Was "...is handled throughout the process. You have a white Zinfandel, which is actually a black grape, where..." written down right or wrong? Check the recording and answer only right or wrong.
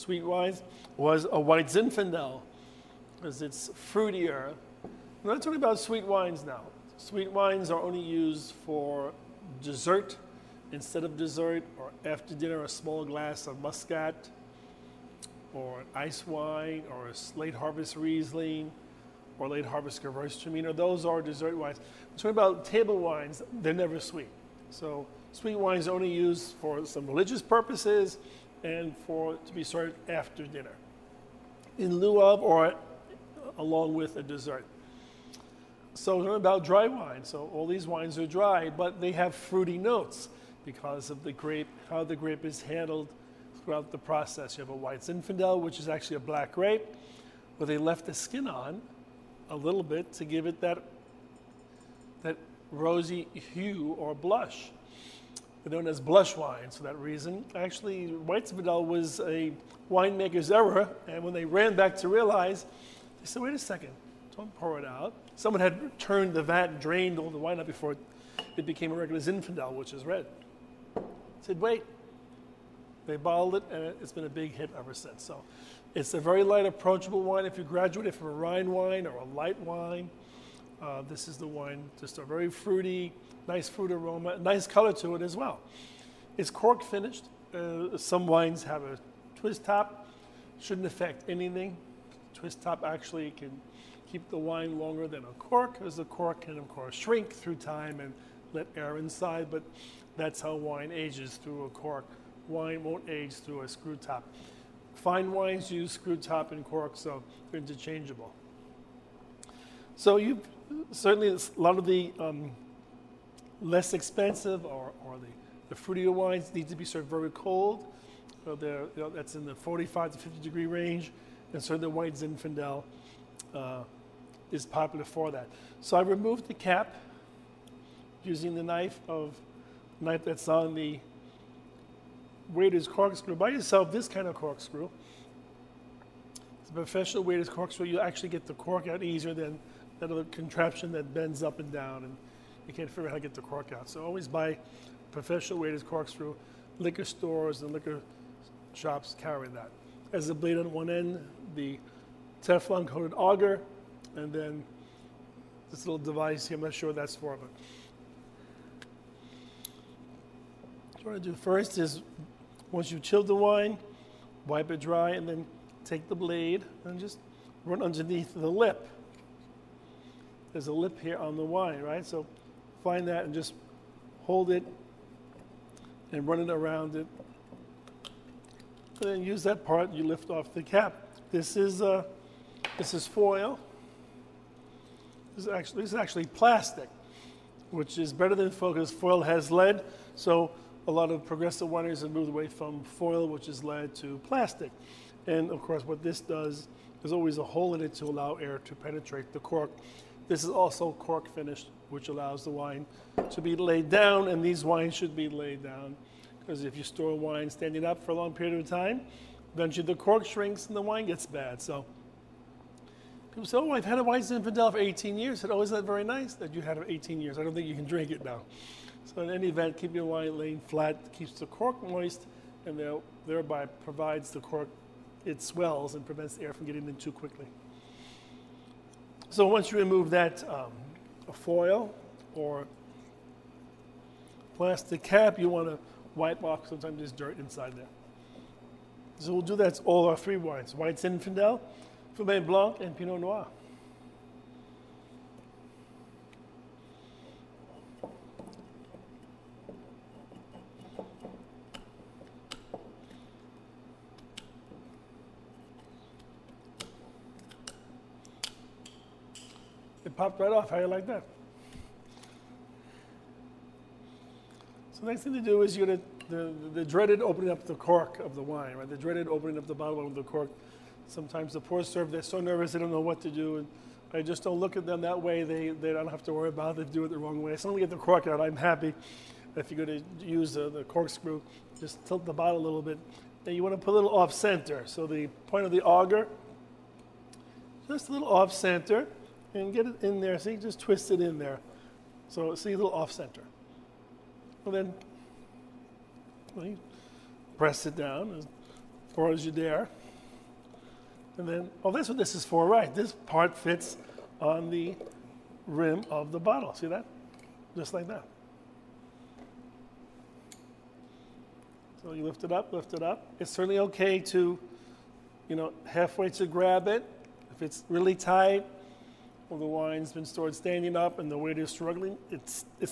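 right.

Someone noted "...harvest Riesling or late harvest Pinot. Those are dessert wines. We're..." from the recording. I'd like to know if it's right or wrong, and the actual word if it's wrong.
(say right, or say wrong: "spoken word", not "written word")
wrong: "Gewürztraminer", not "Pinot".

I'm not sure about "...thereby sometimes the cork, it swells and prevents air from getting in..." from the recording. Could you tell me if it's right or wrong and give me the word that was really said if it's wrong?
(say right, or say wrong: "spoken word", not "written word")
wrong: "provides", not "sometimes".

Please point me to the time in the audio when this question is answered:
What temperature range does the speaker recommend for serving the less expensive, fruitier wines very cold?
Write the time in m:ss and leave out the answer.
1:59.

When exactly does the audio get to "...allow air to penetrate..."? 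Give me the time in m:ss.
3:18.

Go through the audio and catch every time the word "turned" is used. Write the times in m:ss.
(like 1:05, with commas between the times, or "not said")
1:05.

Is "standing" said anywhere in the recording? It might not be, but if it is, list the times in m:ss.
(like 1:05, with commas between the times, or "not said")
3:27, 5:20.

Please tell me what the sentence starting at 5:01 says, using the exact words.
And then, oh, that's what this is for, right?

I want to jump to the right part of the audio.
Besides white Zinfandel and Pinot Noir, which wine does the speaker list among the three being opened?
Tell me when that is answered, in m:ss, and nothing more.
4:02.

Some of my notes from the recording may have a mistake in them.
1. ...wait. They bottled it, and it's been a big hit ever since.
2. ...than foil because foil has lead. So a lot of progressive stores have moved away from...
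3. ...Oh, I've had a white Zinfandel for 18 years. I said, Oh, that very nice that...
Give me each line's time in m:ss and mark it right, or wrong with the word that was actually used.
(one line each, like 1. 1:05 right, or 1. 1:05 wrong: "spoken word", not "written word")
1. 1:11 right
2. 3:08 wrong: "wineries", not "stores"
3. 3:33 right.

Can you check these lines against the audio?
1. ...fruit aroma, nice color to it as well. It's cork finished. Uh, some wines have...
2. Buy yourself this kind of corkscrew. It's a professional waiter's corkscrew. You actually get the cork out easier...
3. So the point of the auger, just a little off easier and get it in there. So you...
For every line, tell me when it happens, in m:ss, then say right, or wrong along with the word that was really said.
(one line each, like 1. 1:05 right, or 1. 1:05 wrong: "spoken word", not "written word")
1. 1:23 right
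2. 2:13 right
3. 4:44 wrong: "center", not "easier".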